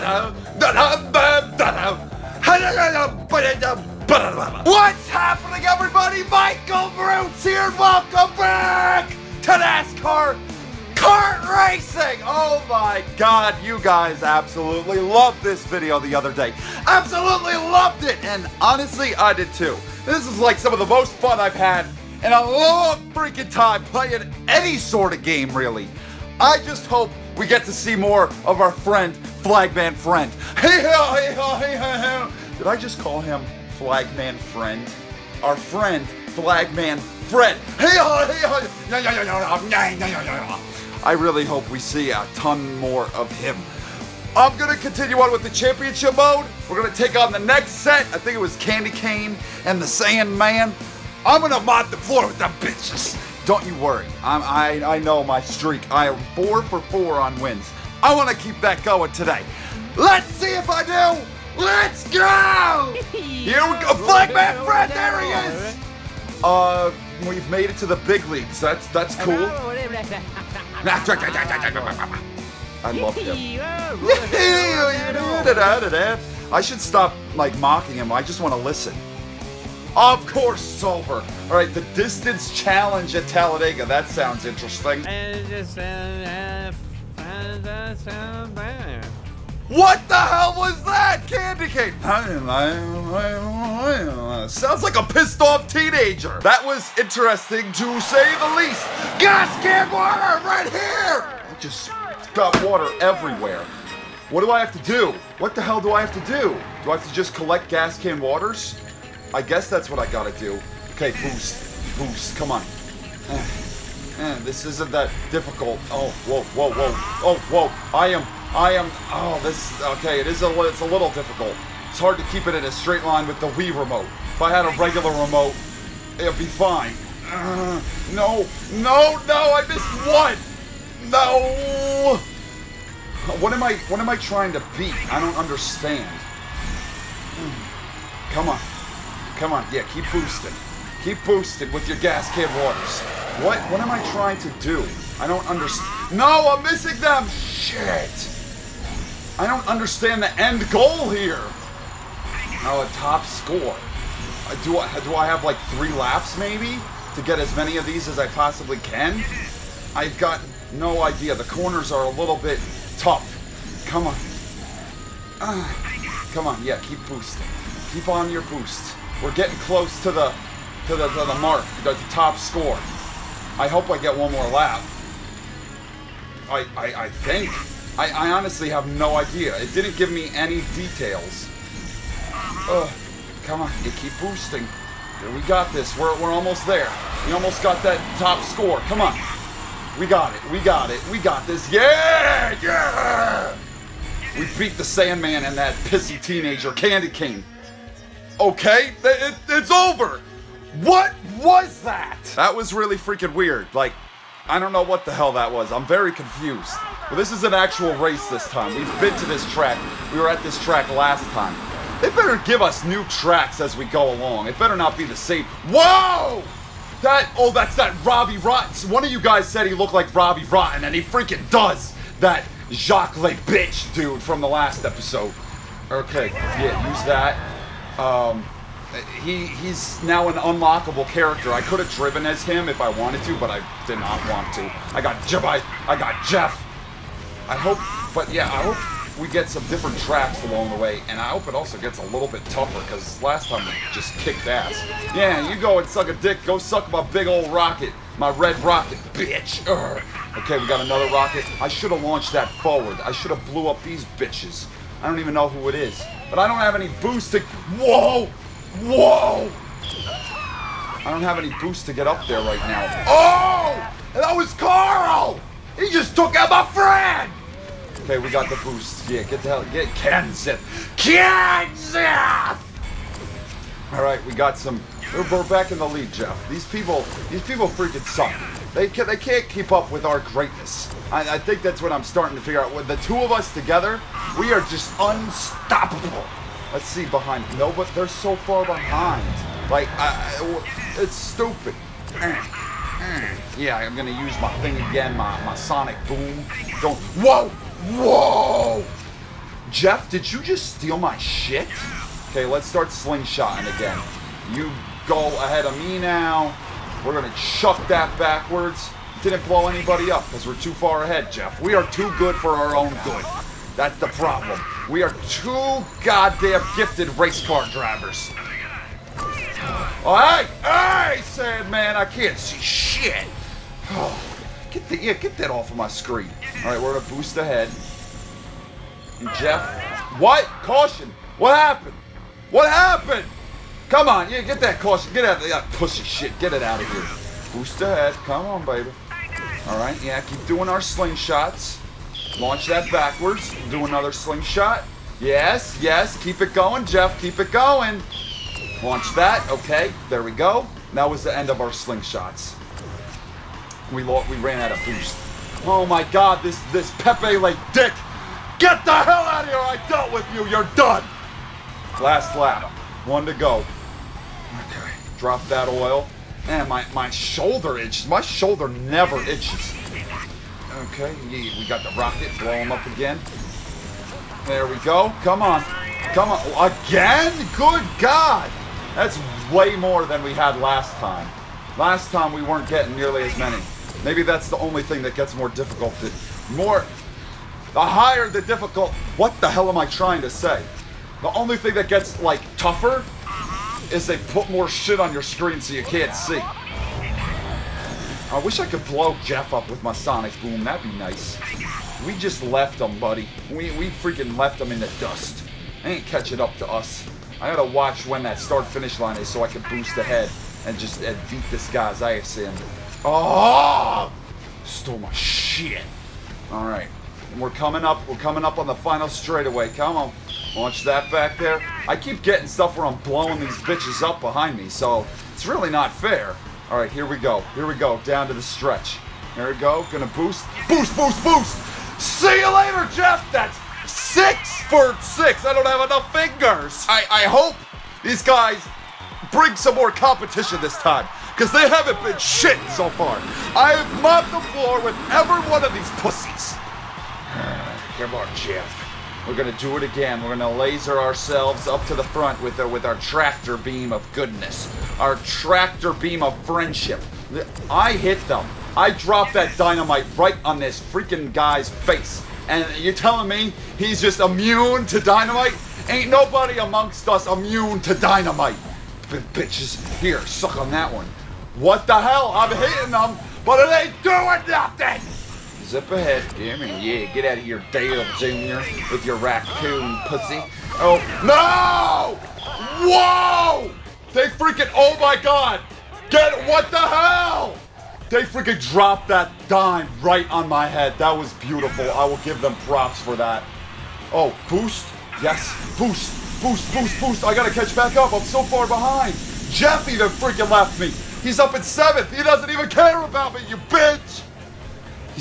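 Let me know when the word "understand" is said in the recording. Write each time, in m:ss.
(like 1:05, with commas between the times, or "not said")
2:15, 2:25, 2:29.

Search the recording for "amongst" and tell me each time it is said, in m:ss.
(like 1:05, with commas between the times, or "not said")
7:46.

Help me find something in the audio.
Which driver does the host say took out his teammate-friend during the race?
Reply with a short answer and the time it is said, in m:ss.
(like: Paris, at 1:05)
Carl, at 4:24.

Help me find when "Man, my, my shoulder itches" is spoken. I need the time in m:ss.
6:06.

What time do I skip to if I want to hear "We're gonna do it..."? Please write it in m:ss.
7:29.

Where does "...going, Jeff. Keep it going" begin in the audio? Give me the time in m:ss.
5:46.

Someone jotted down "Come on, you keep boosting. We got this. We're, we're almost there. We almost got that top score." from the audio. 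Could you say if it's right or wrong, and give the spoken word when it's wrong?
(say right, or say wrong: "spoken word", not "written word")
right.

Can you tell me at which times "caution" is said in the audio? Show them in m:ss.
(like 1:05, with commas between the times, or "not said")
5:30, 5:34.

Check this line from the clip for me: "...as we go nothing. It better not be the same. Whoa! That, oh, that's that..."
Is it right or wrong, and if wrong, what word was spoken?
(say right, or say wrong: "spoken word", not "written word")
wrong: "along", not "nothing".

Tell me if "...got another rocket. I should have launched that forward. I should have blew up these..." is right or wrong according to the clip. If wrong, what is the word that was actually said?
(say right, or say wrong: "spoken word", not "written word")
right.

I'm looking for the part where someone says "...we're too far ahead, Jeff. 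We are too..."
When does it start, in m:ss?
5:10.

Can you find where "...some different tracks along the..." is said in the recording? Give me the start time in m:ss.
3:59.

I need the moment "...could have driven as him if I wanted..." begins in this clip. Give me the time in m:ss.
3:51.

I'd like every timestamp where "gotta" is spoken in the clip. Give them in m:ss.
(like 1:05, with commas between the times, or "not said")
1:50, 6:47, 8:17.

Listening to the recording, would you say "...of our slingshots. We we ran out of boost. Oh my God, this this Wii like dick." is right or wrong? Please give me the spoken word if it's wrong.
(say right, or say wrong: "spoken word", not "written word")
wrong: "Pepe", not "Wii".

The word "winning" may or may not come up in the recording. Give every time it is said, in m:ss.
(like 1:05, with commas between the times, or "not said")
not said.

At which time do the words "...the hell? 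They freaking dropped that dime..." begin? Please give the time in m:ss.
8:06.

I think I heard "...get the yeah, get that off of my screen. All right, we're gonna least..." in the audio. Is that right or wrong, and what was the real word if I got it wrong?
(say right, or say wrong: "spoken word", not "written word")
wrong: "boost", not "least".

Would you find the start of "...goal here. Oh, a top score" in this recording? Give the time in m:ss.
2:30.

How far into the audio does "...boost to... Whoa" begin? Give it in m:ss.
4:17.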